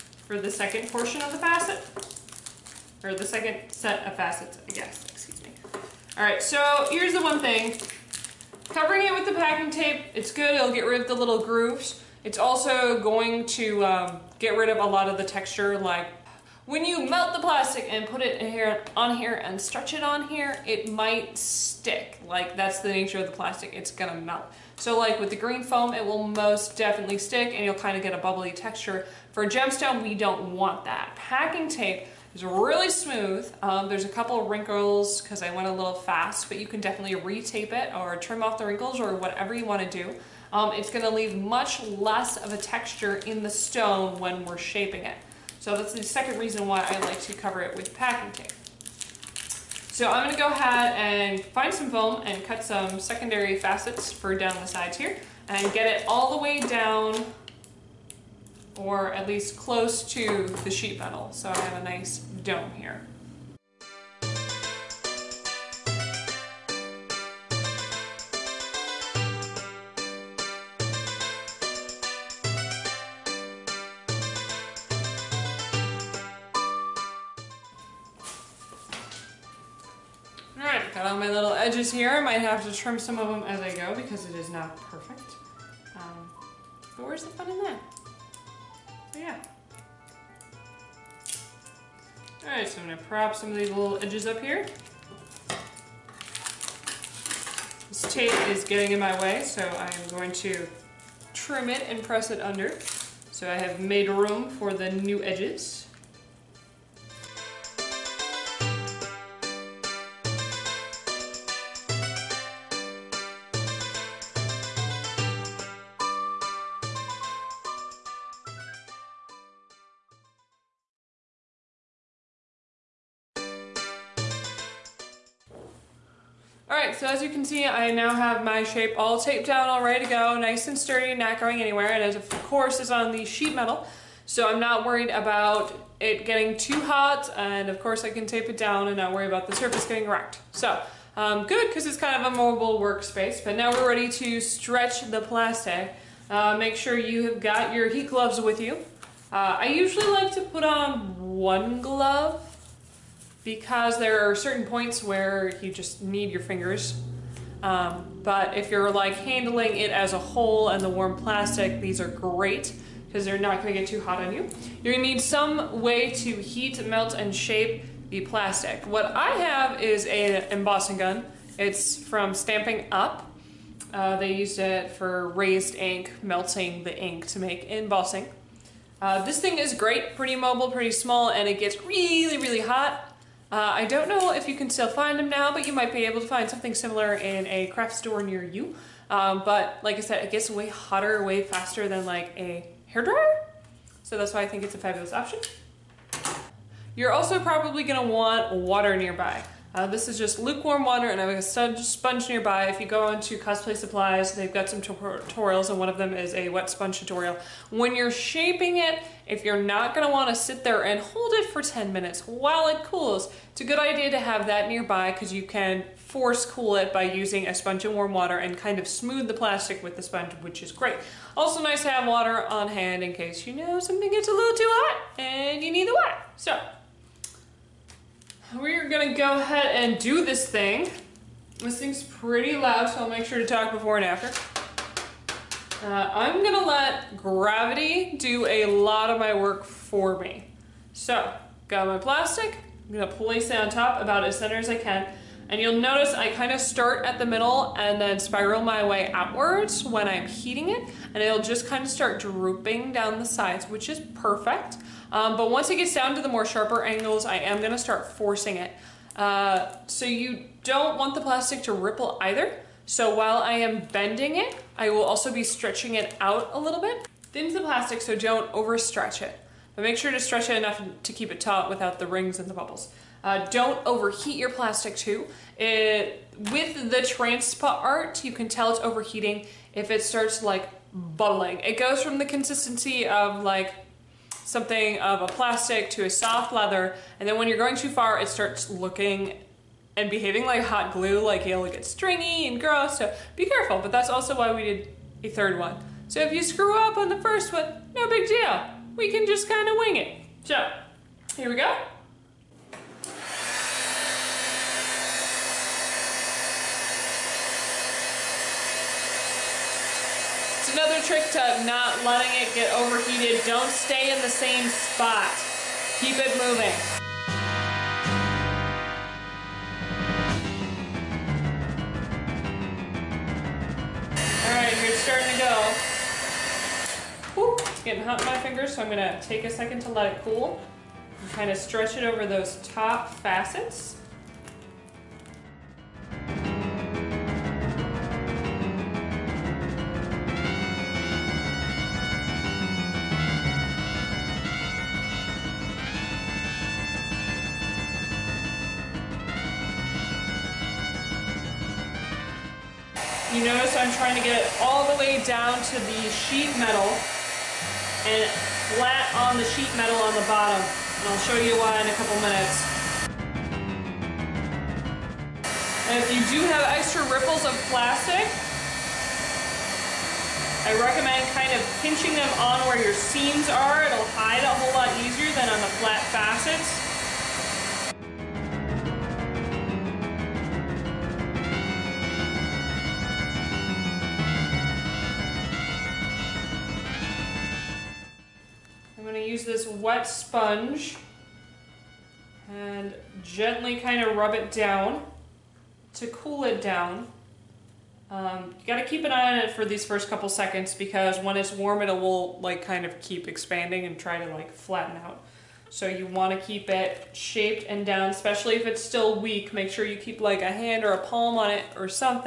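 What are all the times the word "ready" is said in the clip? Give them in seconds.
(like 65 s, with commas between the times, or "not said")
129 s, 143 s.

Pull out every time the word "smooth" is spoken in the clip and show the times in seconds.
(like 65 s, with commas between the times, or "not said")
32 s, 218 s.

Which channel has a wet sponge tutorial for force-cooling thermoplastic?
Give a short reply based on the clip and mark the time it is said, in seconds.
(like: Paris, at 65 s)
Cosplay Supplies, at 203 s.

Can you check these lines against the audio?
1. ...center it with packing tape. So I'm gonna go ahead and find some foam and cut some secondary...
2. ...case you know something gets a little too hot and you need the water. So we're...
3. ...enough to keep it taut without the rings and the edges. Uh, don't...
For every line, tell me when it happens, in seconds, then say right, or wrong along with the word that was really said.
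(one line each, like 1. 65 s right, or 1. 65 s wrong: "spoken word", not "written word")
1. 47 s wrong: "cover", not "center"
2. 223 s right
3. 270 s wrong: "bubbles", not "edges".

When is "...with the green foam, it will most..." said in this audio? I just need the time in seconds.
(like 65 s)
25 s.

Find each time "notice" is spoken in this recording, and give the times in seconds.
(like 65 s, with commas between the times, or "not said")
245 s, 353 s.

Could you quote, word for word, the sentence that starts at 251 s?
And it'll just kind of start drooping down the sides, which is perfect.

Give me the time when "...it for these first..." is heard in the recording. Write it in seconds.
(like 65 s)
399 s.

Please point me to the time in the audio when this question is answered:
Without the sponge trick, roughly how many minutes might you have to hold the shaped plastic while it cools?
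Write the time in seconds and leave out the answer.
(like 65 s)
211 s.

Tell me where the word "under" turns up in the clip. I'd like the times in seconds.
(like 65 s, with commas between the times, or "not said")
102 s.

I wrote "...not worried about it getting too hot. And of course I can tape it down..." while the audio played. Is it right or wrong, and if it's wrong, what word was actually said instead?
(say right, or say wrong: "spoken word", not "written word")
right.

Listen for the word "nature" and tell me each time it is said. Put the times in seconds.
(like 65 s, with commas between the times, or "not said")
22 s.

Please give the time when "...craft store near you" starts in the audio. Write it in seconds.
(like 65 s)
187 s.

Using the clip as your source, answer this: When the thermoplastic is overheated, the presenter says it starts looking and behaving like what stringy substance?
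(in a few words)
Hot glue.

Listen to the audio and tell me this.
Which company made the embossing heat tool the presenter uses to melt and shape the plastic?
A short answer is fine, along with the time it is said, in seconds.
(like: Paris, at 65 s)
Stampin' Up, at 172 s.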